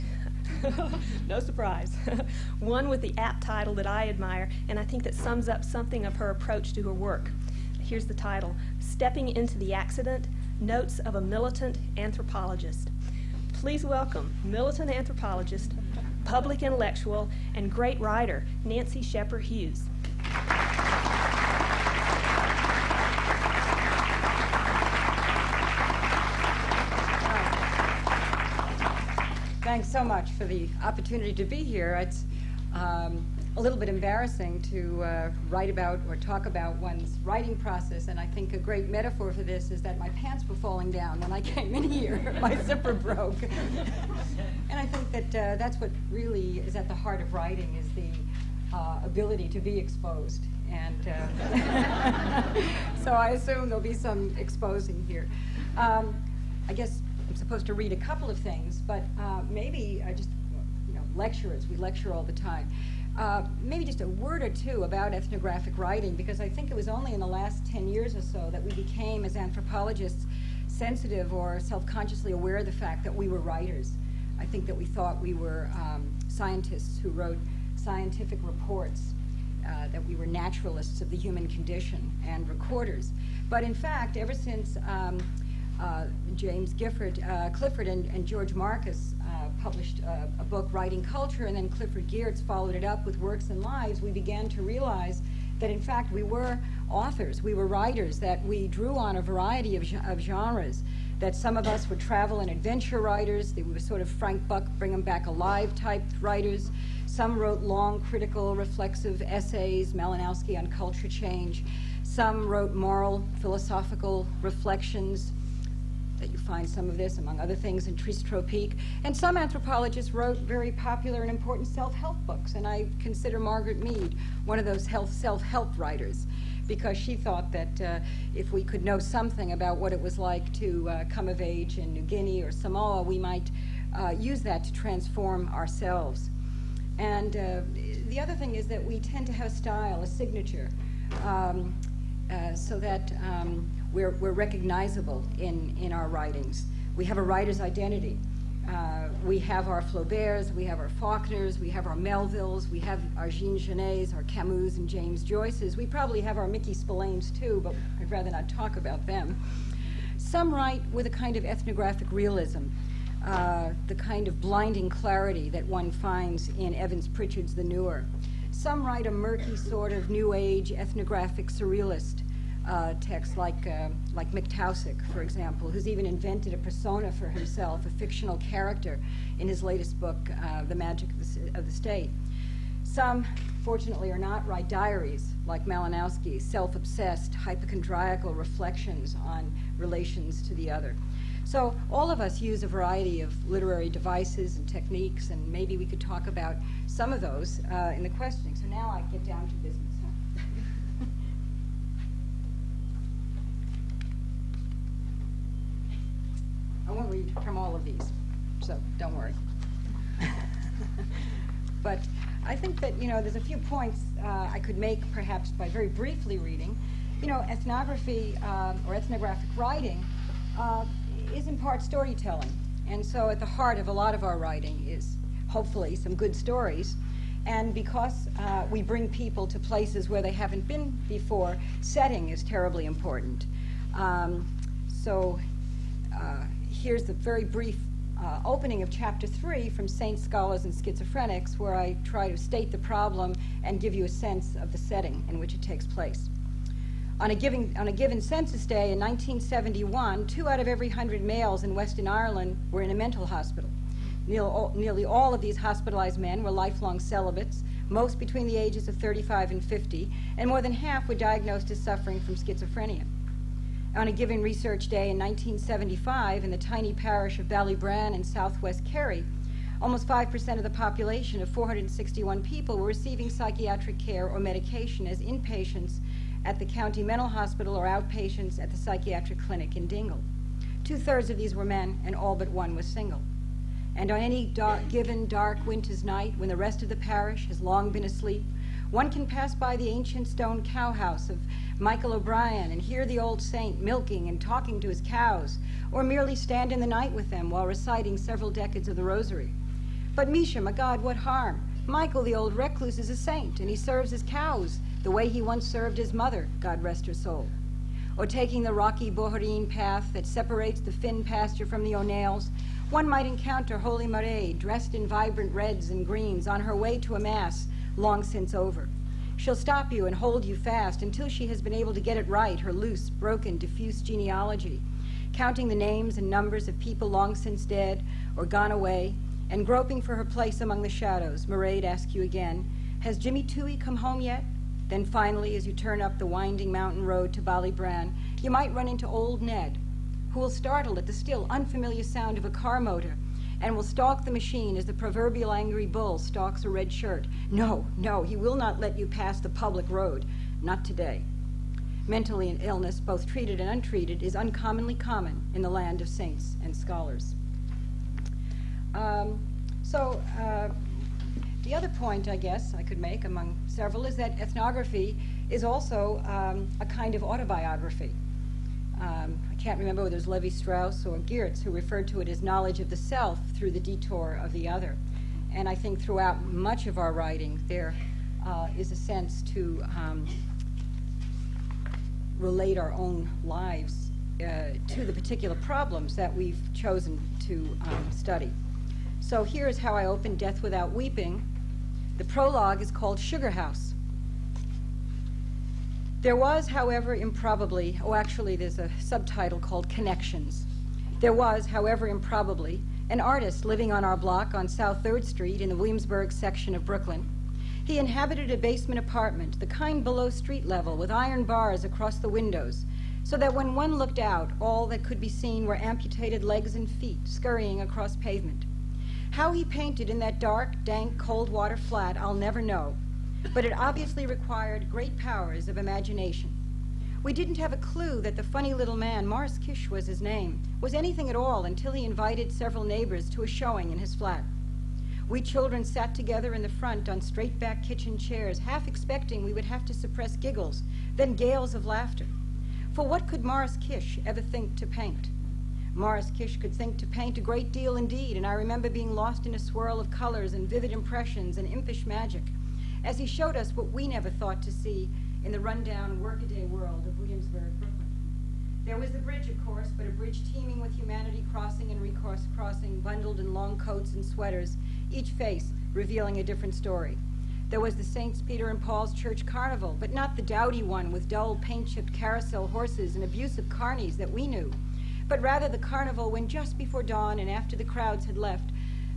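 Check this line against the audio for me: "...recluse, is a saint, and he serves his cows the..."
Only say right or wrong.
right.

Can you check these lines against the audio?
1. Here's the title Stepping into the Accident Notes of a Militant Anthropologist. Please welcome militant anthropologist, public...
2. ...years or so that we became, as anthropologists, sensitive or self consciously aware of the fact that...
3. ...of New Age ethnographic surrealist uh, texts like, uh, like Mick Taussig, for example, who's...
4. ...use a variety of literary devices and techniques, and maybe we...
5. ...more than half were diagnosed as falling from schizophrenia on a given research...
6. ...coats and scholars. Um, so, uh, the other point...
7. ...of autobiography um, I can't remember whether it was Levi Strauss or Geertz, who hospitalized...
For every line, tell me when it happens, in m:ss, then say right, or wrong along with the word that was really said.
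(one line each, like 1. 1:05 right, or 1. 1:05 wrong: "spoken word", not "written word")
1. 0:07 right
2. 1:07 right
3. 2:49 right
4. 3:12 right
5. 4:20 wrong: "suffering", not "falling"
6. 5:56 wrong: "saints", not "coats"
7. 6:07 wrong: "referred", not "hospitalized".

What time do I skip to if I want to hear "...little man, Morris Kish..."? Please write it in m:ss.
7:08.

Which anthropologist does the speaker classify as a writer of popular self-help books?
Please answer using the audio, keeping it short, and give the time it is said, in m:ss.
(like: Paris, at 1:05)
Margaret Mead, at 2:03.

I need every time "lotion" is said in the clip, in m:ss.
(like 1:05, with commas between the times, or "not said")
not said.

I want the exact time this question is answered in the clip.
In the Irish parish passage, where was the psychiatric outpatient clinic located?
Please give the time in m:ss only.
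4:39.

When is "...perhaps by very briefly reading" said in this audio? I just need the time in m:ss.
3:35.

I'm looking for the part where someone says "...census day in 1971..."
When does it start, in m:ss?
4:08.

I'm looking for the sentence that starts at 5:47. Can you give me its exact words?
No, no, he will not let you pass the public road.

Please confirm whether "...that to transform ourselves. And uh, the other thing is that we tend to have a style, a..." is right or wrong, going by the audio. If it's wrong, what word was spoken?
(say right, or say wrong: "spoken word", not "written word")
right.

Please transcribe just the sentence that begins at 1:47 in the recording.
Some wrote long, critical, reflexive essays, Malinowski on culture change.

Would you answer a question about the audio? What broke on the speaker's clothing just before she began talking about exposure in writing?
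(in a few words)
zipper.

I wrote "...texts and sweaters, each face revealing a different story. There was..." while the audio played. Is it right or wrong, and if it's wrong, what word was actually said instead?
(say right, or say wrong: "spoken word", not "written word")
wrong: "coats", not "texts".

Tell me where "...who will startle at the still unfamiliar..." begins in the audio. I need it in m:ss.
5:40.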